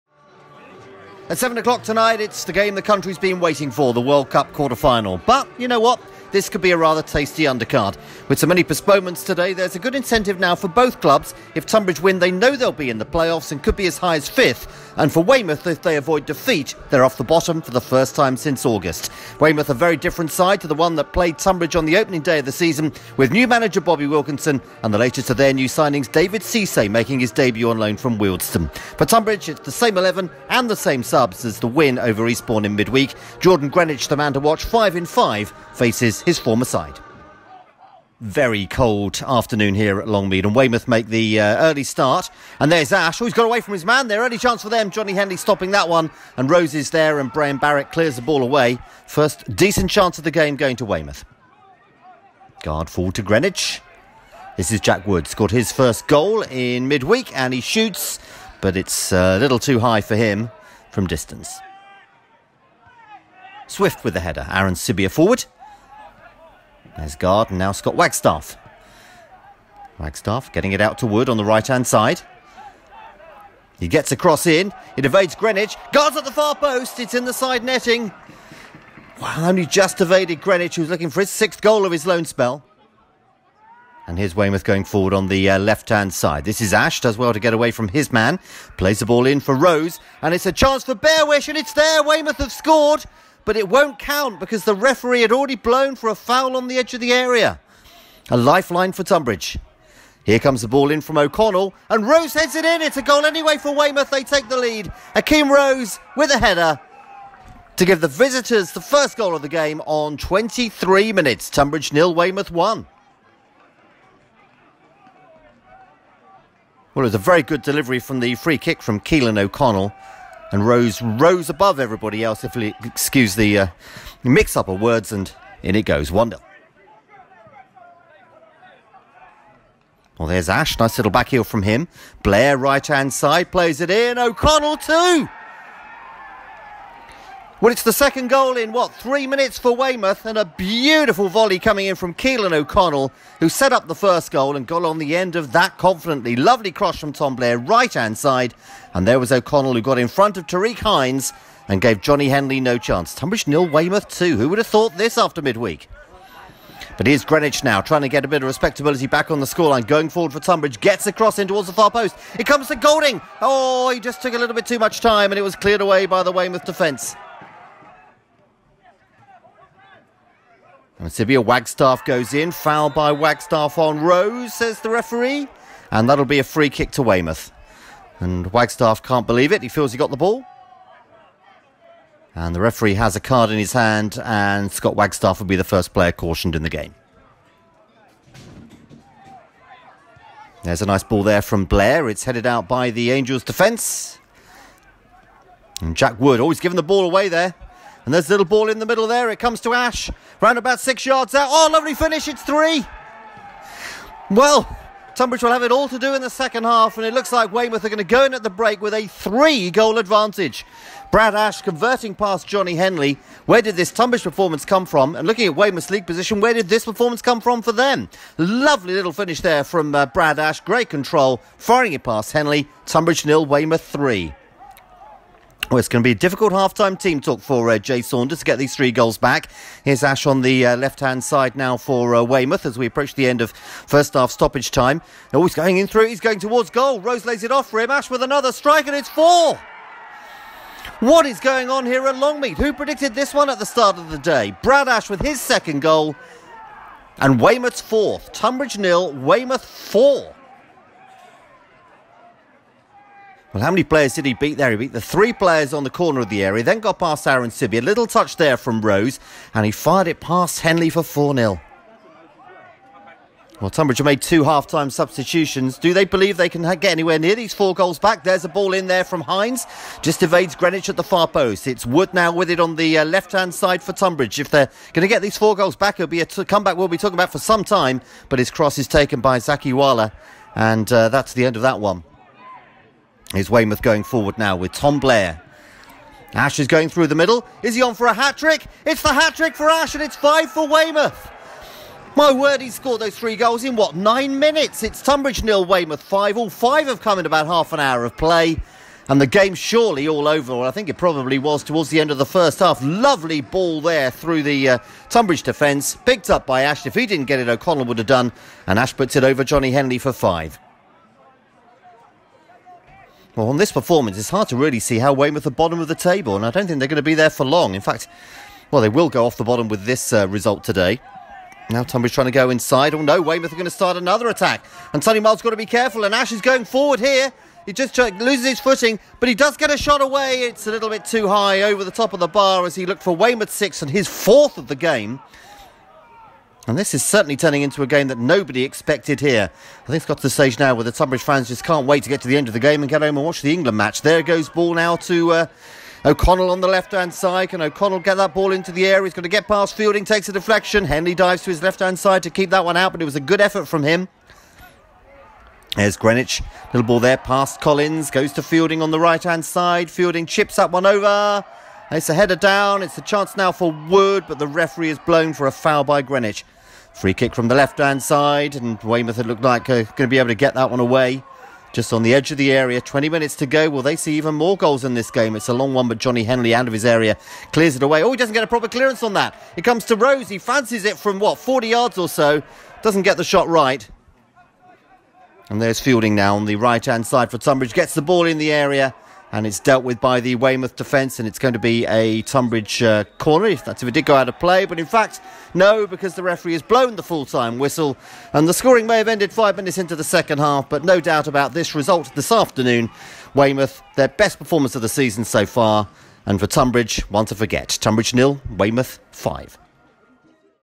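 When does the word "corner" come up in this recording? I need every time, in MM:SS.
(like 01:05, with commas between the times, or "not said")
04:15, 06:33.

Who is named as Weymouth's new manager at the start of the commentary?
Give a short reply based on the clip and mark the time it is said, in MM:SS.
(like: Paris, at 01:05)
Bobby Wilkinson, at 00:23.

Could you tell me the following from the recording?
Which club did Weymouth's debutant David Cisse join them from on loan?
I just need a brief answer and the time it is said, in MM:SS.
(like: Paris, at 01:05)
Wealdstone, at 00:28.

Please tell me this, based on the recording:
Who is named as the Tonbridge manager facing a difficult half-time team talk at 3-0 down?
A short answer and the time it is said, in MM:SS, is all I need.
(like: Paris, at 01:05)
Jay Saunders, at 03:47.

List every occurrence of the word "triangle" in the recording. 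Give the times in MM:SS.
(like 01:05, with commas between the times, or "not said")
not said.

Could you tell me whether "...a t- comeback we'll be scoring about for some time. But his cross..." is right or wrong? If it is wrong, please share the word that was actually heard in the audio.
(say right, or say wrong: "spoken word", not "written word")
wrong: "talking", not "scoring".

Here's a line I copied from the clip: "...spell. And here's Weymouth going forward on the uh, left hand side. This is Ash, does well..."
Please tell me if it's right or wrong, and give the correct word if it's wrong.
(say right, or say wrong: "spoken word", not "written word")
right.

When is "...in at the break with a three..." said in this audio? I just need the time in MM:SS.
03:28.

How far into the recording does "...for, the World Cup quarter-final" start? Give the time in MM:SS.
00:03.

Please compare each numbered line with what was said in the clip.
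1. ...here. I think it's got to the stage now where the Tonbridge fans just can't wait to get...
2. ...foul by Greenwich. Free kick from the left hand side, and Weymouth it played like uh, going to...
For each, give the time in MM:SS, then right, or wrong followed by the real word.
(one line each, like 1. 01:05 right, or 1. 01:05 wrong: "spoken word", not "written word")
1. 05:39 right
2. 06:05 wrong: "looked", not "played".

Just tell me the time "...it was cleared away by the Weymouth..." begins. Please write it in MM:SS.
02:45.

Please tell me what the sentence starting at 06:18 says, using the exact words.
Oh, he doesn't get a proper clearance on that.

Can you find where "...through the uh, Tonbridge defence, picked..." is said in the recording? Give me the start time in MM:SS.
05:04.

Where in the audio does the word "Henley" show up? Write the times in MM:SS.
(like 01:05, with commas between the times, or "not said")
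00:45, 02:32, 03:32, 03:42, 04:20, 05:09, 05:50, 06:16.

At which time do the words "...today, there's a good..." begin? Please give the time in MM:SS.
00:09.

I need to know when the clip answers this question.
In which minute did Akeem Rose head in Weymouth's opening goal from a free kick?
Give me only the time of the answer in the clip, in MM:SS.
01:50.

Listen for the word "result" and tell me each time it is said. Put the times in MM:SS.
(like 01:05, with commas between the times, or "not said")
05:20, 06:41.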